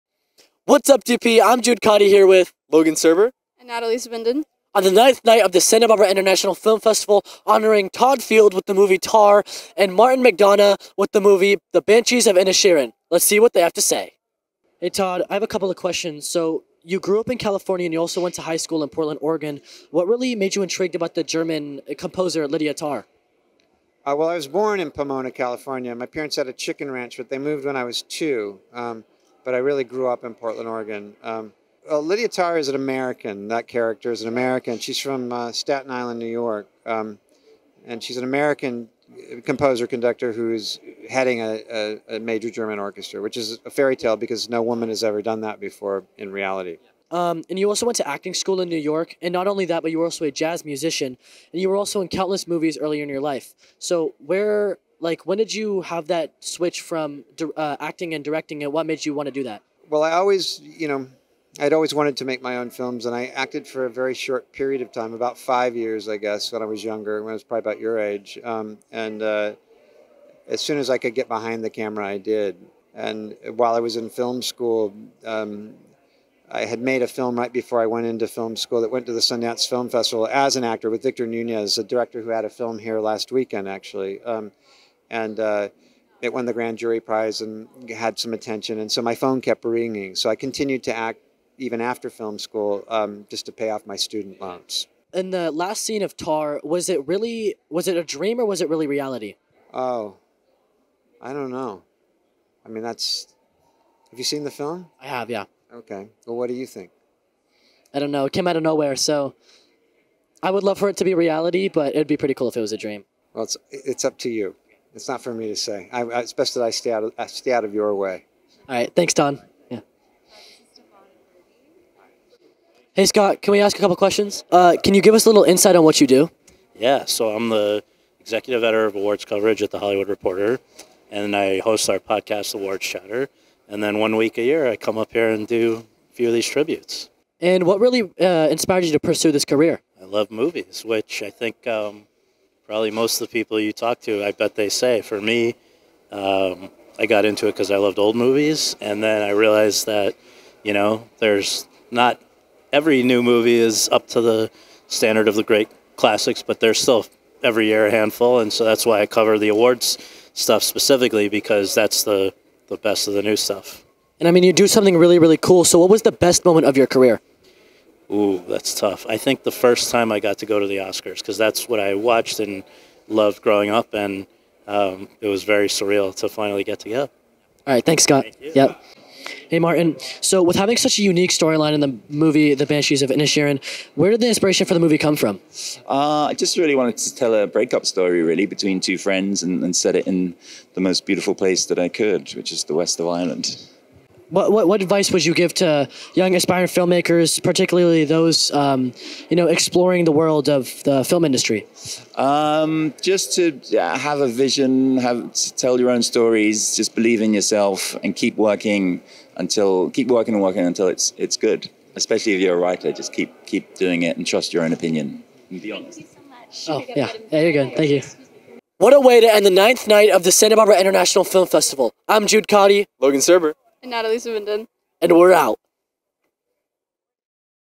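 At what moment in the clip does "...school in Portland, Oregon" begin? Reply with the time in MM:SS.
00:18.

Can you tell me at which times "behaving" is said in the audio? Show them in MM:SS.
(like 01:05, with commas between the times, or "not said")
not said.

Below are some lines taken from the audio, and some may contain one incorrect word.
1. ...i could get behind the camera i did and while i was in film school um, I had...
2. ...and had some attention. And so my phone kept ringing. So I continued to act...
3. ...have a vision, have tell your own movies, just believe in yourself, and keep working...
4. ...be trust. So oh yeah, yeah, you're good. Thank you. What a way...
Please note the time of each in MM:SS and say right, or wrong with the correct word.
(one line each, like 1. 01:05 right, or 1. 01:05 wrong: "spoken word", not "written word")
1. 01:10 right
2. 01:27 right
3. 03:23 wrong: "stories", not "movies"
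4. 03:35 wrong: "honest", not "trust".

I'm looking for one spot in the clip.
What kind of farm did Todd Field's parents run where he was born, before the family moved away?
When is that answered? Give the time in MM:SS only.
00:26.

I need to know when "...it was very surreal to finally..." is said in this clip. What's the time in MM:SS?
02:55.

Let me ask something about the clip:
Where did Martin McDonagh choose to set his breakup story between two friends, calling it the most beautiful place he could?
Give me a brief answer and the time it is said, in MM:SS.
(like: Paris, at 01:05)
The west of Ireland, at 03:12.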